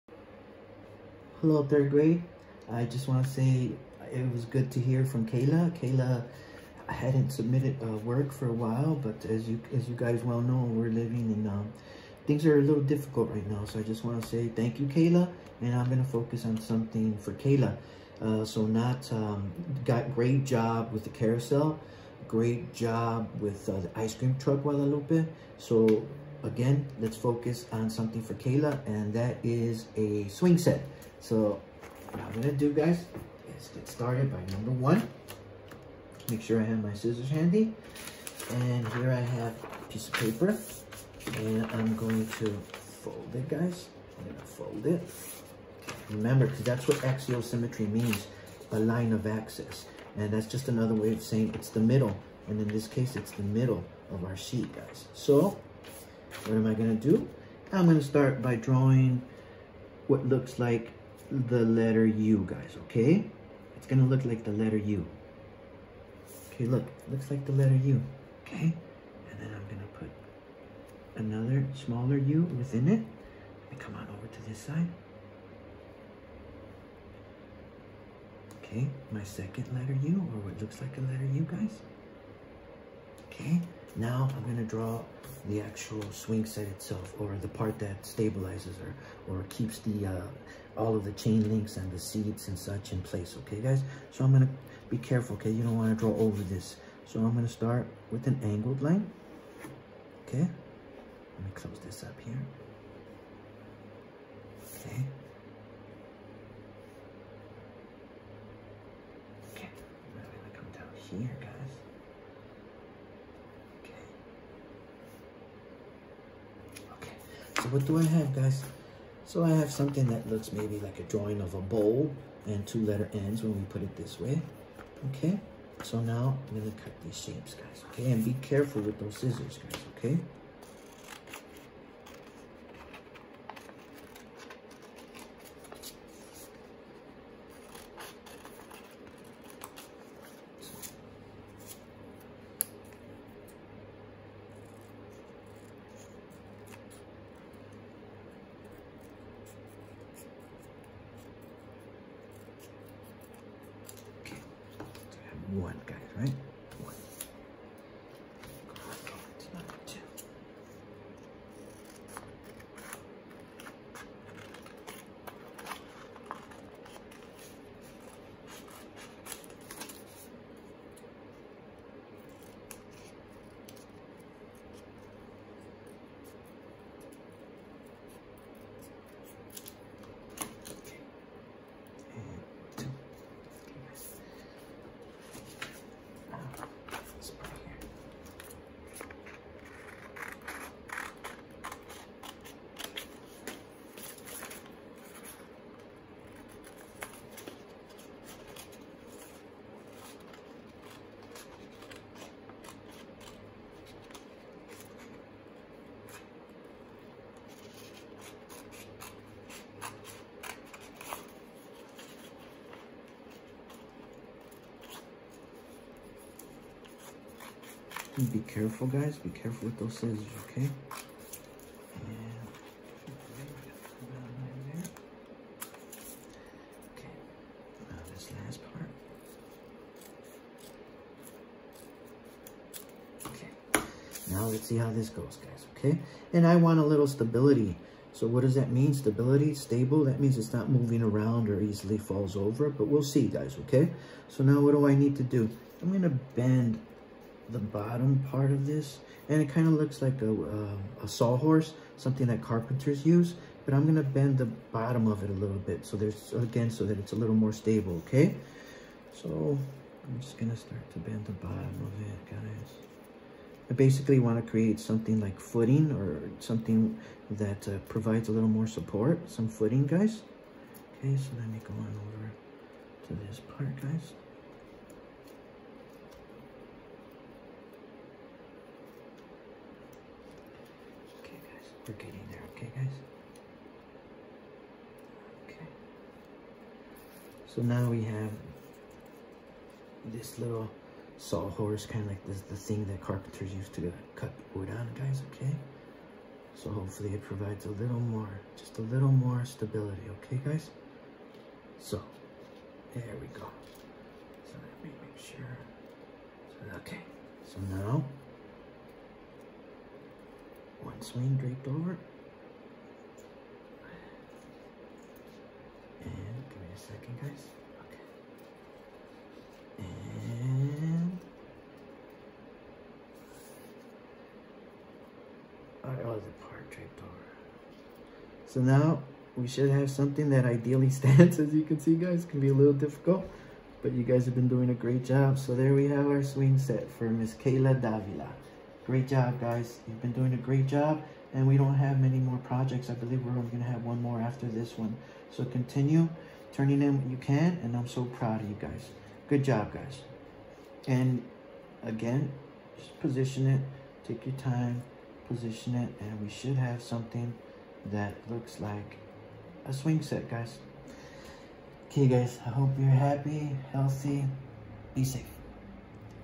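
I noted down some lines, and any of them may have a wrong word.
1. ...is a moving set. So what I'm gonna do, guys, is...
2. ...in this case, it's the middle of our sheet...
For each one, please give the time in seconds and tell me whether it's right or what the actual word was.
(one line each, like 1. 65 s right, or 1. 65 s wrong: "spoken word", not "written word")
1. 29 s wrong: "swing", not "moving"
2. 52 s right.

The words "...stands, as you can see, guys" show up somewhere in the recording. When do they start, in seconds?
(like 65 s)
330 s.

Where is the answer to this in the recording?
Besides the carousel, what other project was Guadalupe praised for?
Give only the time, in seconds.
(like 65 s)
23 s.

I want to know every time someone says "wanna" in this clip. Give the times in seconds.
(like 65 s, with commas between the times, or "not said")
95 s, 264 s.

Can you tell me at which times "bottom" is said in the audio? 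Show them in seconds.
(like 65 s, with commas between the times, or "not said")
247 s, 254 s, 261 s.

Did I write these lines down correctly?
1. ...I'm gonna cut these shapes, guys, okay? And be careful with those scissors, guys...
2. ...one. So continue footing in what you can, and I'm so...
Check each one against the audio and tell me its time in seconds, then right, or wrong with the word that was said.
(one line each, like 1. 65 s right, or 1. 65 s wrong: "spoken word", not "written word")
1. 126 s right
2. 344 s wrong: "turning", not "footing".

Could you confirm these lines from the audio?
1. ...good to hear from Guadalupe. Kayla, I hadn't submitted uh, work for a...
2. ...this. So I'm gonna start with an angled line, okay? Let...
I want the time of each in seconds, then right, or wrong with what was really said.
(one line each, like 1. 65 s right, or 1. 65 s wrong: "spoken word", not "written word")
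1. 4 s wrong: "Kayla", not "Guadalupe"
2. 96 s right.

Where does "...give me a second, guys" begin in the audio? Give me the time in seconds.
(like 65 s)
316 s.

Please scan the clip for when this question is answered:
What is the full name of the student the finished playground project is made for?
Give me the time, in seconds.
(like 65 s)
337 s.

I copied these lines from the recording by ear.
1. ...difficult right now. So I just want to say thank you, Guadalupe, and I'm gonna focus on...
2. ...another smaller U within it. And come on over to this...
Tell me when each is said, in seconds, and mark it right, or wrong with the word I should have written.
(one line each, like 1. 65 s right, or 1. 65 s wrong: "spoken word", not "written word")
1. 12 s wrong: "Kayla", not "Guadalupe"
2. 71 s right.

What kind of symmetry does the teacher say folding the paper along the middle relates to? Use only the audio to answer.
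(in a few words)
axial symmetry.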